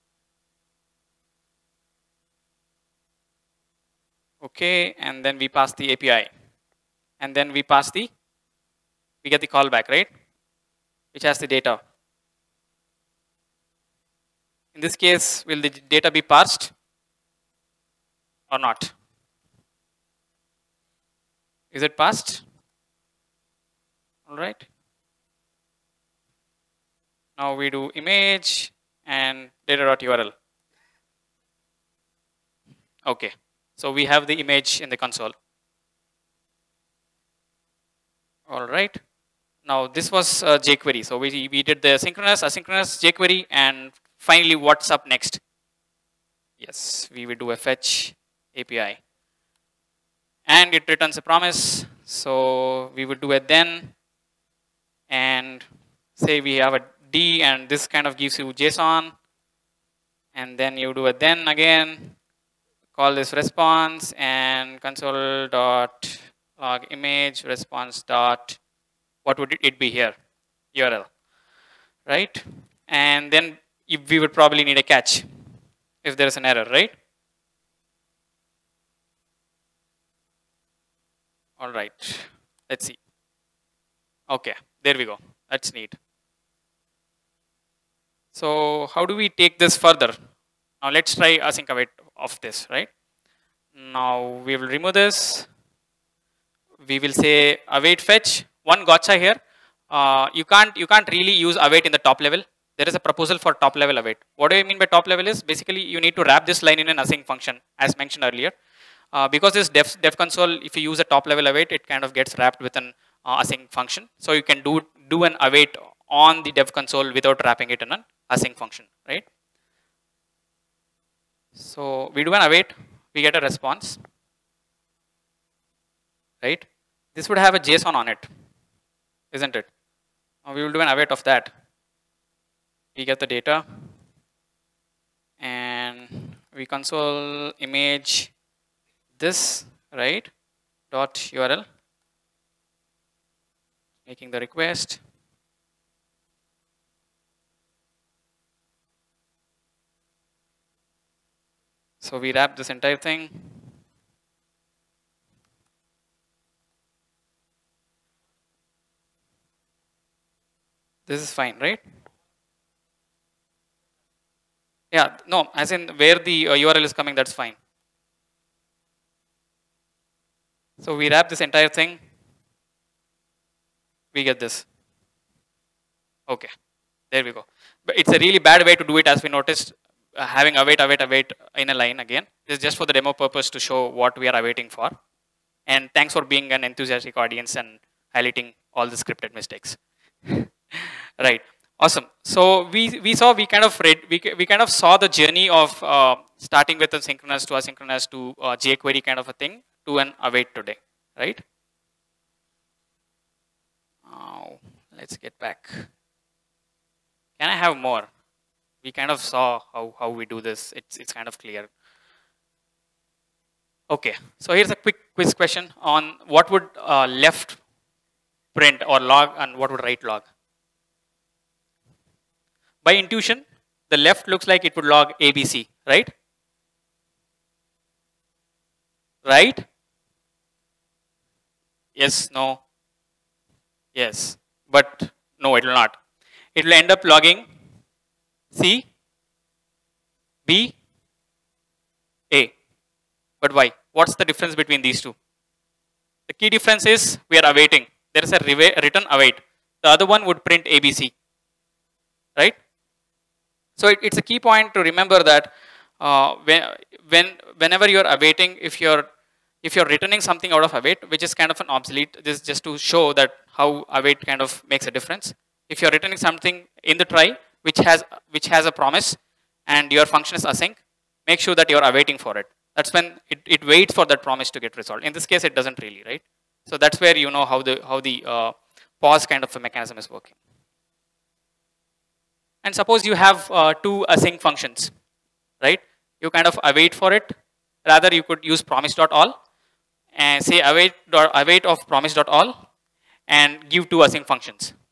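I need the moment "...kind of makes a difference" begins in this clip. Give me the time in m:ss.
4:24.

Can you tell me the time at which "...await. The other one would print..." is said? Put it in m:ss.
4:09.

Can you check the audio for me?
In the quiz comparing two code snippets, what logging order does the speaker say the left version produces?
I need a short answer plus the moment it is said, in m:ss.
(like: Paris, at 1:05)
C, B, A, at 3:58.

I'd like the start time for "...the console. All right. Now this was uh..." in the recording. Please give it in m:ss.
0:34.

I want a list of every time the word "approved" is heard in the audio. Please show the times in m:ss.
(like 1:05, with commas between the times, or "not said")
not said.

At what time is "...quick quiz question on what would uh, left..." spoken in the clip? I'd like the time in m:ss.
3:34.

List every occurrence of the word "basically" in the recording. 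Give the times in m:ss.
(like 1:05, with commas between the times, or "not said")
1:45.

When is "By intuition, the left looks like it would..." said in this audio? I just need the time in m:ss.
3:42.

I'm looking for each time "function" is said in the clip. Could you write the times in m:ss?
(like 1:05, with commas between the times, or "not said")
1:47, 1:53, 1:58, 4:30, 4:44, 4:54.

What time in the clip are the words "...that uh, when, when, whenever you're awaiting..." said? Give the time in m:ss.
4:15.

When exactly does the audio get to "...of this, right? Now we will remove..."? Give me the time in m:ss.
1:32.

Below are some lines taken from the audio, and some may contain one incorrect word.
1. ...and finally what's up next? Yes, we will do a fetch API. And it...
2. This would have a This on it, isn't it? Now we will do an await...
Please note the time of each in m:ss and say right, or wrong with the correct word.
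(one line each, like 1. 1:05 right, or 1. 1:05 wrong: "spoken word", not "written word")
1. 0:43 right
2. 2:07 wrong: "JSON", not "This".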